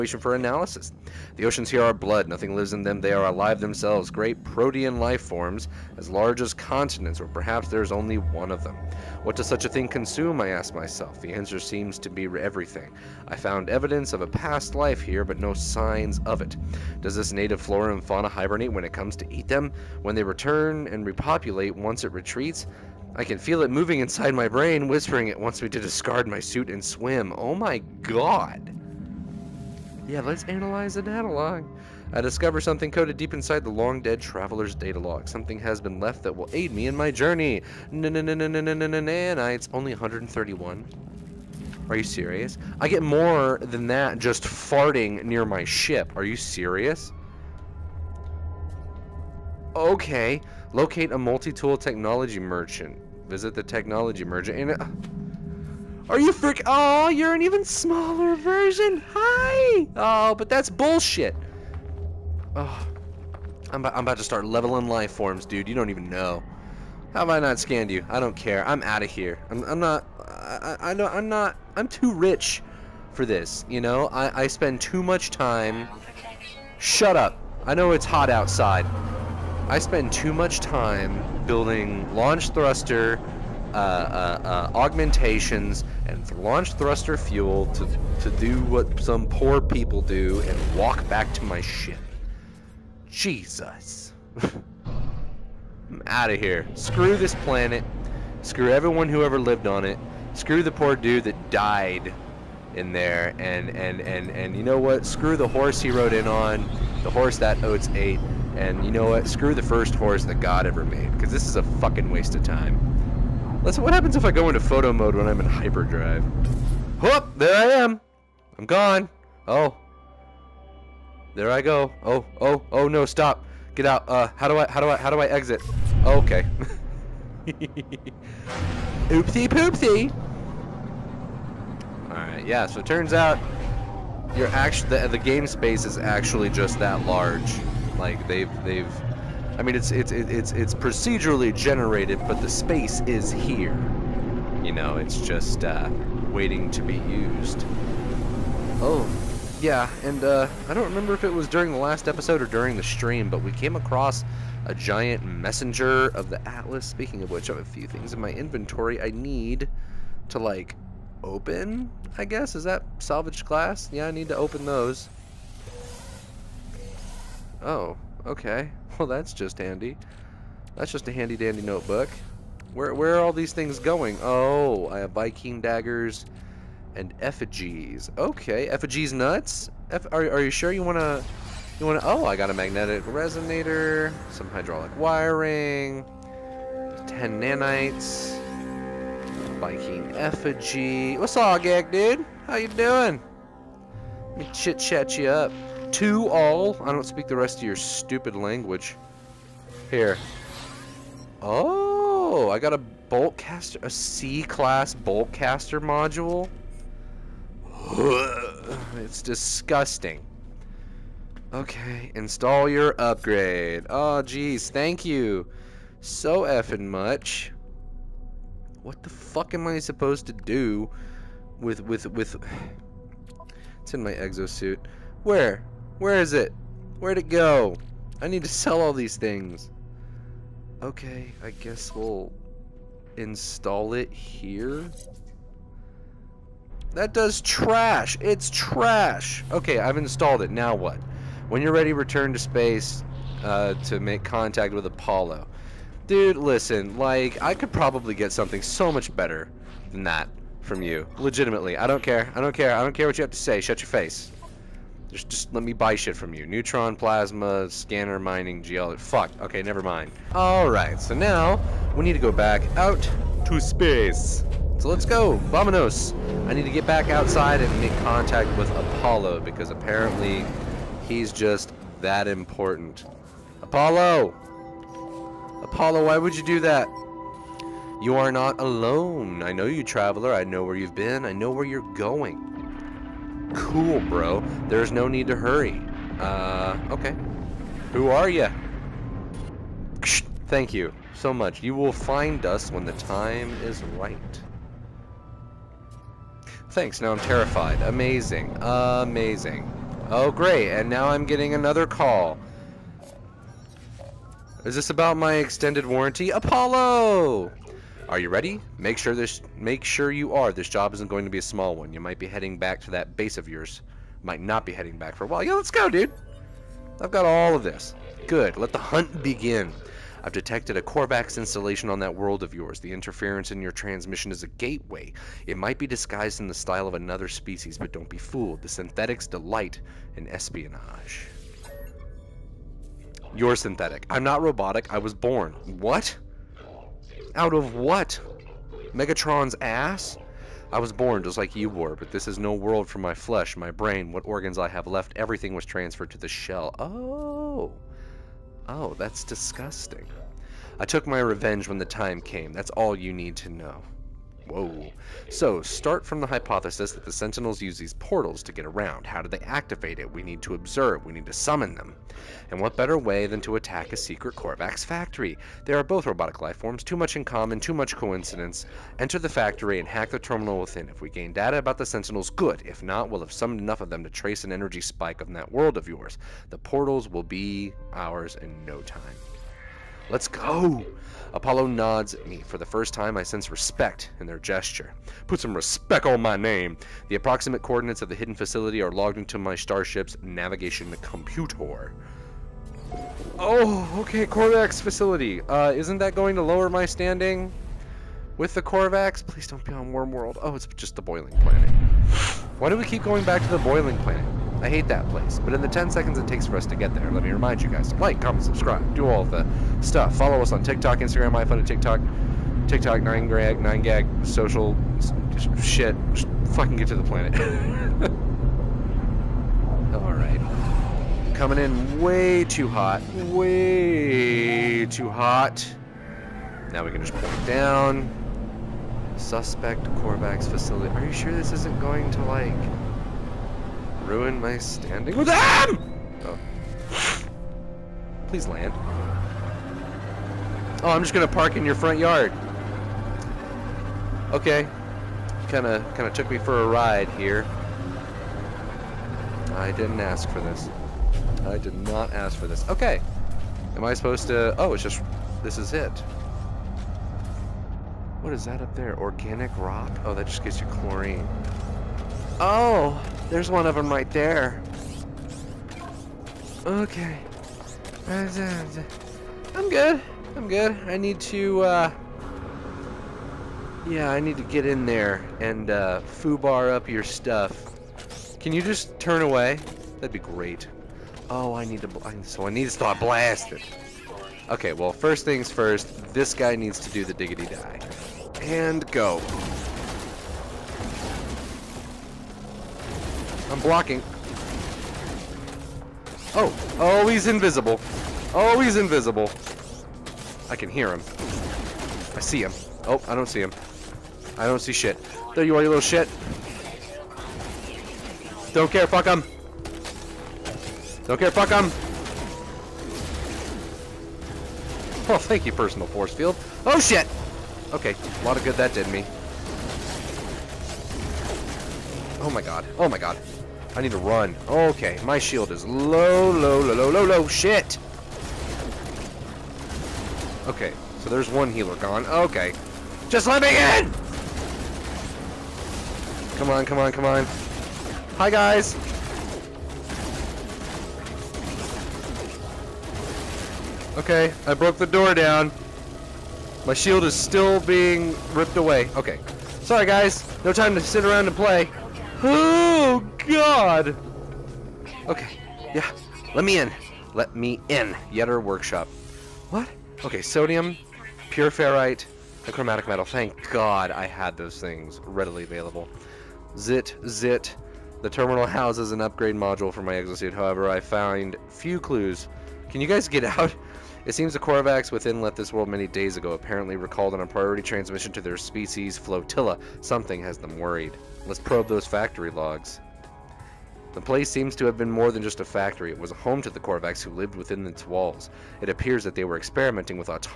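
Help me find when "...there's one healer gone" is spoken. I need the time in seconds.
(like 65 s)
531 s.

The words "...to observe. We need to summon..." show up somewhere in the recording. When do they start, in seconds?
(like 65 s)
360 s.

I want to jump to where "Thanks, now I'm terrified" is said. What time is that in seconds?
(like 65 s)
296 s.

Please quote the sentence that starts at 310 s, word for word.
This job isn't going to be a small one.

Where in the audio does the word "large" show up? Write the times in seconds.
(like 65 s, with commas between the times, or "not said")
6 s, 137 s.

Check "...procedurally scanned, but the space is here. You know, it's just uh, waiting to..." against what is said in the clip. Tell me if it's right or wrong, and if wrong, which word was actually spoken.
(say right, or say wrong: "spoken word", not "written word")
wrong: "generated", not "scanned".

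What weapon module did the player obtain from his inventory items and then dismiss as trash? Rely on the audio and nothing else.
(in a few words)
C-class bolt caster.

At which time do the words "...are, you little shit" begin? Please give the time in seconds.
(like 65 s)
505 s.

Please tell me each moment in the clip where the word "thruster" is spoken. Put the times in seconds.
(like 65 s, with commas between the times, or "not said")
82 s, 86 s.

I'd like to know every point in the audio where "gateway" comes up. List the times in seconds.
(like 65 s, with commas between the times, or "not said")
324 s.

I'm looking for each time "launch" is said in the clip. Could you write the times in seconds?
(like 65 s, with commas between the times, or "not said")
82 s, 86 s.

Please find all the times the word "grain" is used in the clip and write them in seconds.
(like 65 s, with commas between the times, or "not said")
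not said.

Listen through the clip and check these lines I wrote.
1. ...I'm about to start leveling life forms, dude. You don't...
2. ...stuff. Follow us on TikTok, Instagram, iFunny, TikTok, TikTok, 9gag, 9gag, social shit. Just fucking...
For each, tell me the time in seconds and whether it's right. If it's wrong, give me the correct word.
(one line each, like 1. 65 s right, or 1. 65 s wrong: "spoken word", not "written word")
1. 63 s right
2. 409 s right.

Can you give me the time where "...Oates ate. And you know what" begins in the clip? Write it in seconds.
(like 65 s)
107 s.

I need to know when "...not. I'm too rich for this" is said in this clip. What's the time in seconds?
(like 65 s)
71 s.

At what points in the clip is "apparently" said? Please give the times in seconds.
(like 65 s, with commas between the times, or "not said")
269 s, 576 s.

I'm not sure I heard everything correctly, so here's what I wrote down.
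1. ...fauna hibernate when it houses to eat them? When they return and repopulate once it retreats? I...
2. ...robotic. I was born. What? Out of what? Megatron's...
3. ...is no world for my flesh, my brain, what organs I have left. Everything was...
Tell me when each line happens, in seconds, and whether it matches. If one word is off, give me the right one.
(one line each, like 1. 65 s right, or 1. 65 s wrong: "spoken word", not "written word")
1. 18 s wrong: "comes", not "houses"
2. 334 s right
3. 342 s right.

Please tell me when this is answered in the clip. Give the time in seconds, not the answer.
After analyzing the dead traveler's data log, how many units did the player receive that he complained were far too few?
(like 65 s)
39 s.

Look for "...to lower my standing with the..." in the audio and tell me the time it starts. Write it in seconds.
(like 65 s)
396 s.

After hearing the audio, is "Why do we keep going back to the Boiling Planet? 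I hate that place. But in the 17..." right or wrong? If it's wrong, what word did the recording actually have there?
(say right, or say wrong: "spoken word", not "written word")
wrong: "10", not "17".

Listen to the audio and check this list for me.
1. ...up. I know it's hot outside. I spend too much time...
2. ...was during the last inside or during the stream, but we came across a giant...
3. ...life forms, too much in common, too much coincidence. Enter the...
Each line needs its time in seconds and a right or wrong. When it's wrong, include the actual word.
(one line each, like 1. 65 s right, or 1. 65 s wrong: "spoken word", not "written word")
1. 77 s right
2. 151 s wrong: "episode", not "inside"
3. 366 s right.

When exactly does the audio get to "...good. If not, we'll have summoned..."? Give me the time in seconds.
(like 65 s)
372 s.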